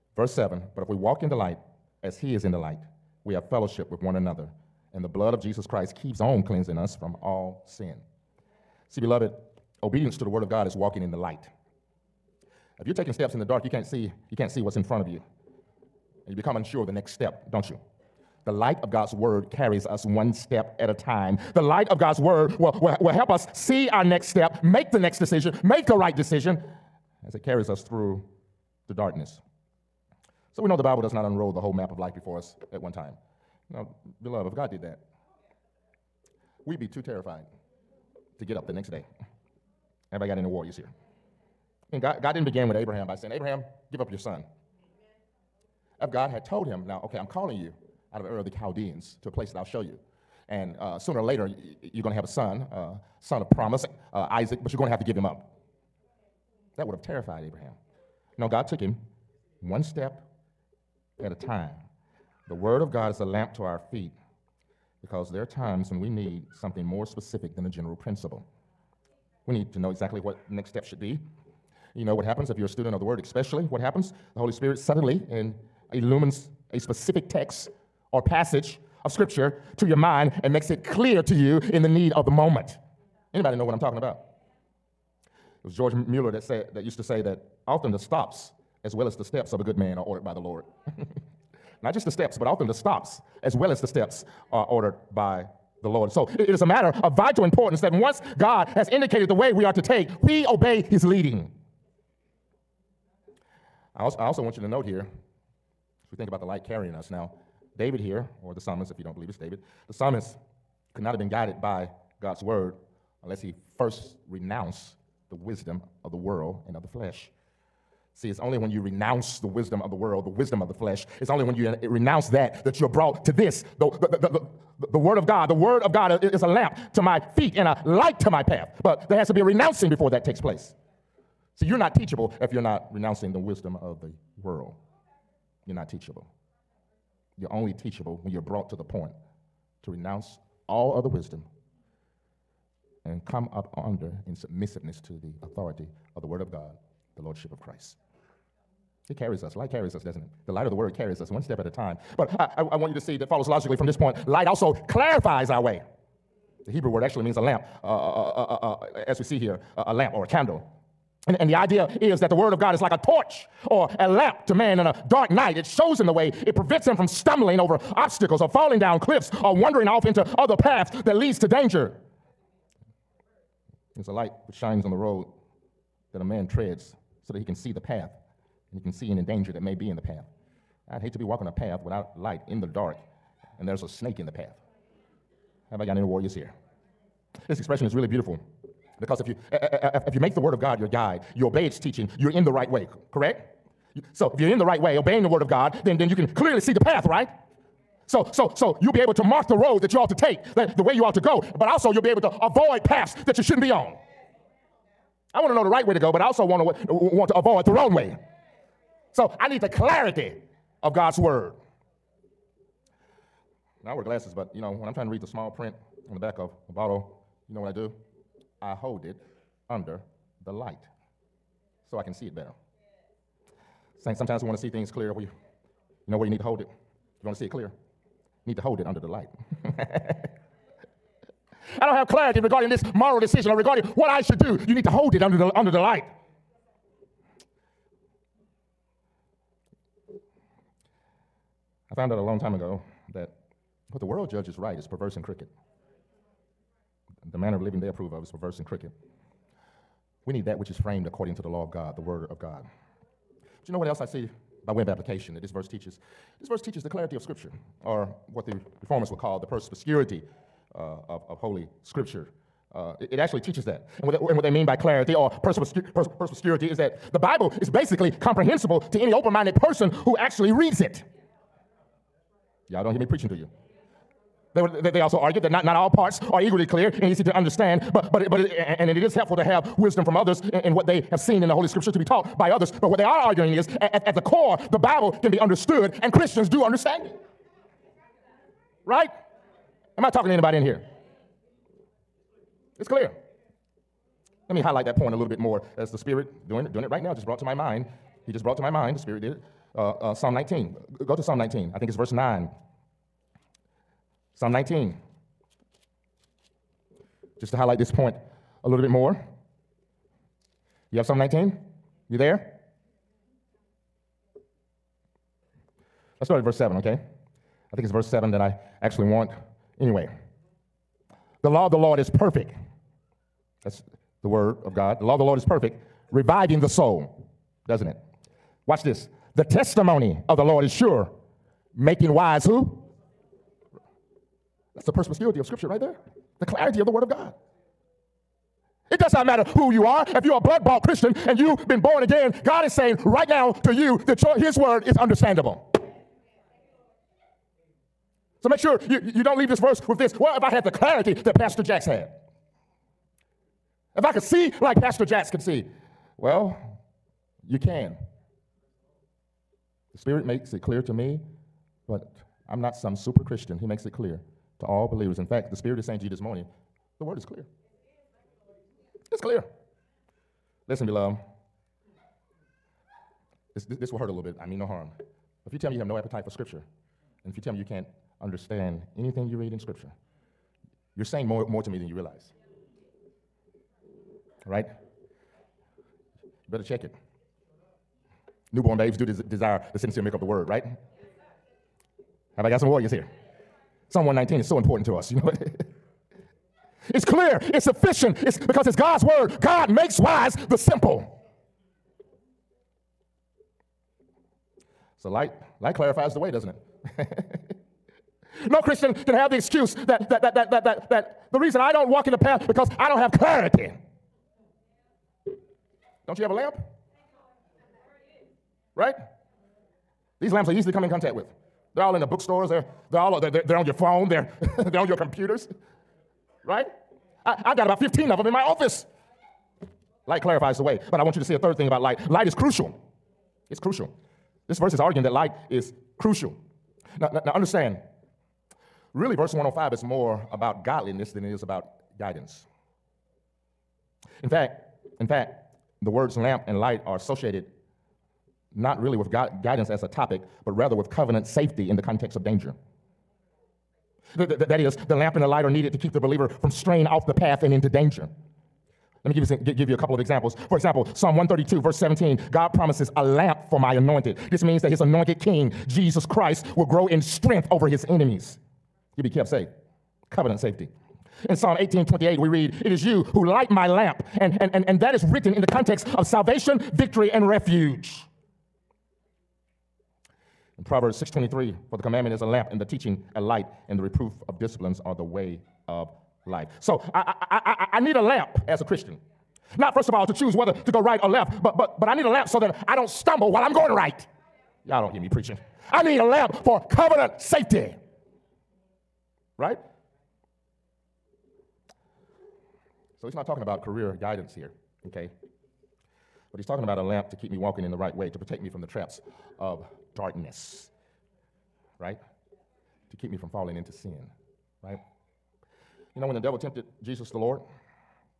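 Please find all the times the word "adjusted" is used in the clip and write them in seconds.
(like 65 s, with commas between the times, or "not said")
not said.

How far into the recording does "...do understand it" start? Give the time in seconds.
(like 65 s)
286 s.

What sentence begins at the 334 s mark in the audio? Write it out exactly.
That's the perspicuity of Scripture right there.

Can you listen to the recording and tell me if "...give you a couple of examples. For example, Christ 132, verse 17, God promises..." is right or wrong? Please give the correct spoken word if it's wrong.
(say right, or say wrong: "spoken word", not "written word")
wrong: "Psalm", not "Christ".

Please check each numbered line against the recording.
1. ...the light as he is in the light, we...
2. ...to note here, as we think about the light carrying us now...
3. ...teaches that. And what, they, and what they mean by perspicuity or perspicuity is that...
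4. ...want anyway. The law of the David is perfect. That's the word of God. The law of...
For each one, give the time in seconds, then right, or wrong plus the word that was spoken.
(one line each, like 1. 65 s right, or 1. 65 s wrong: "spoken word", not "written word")
1. 1 s right
2. 104 s right
3. 263 s wrong: "clarity", not "perspicuity"
4. 319 s wrong: "Lord", not "David".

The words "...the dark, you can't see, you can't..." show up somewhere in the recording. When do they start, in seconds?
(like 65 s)
13 s.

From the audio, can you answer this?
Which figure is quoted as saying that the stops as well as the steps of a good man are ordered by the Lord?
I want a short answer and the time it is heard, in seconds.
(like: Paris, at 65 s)
George Mueller, at 85 s.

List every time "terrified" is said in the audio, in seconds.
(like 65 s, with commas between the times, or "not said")
37 s, 57 s.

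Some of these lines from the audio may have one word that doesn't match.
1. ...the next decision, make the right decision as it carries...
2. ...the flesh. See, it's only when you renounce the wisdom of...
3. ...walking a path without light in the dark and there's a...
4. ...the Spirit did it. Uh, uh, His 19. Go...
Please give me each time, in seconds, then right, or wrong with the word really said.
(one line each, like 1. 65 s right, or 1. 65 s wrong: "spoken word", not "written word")
1. 24 s right
2. 116 s right
3. 181 s right
4. 298 s wrong: "Psalm", not "His".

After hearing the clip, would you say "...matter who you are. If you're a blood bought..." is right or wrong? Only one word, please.
right.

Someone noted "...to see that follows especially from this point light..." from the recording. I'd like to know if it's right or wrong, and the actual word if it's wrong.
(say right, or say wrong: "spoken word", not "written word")
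wrong: "logically", not "especially".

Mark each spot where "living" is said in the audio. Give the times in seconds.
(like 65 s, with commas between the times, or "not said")
247 s.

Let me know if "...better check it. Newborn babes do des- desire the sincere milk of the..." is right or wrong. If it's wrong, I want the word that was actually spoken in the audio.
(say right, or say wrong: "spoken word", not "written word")
right.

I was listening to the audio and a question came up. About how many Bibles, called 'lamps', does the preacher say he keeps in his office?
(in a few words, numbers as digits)
15.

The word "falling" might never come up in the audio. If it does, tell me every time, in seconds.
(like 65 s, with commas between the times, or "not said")
168 s, 513 s.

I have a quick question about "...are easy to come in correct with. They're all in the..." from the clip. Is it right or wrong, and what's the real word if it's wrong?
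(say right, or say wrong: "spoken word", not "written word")
wrong: "contact", not "correct".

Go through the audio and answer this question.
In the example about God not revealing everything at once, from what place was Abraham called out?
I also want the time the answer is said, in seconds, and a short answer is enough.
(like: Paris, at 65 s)
Ur of the Chaldeans, at 48 s.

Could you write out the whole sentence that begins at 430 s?
But I want you to see a third thing about light light is crucial.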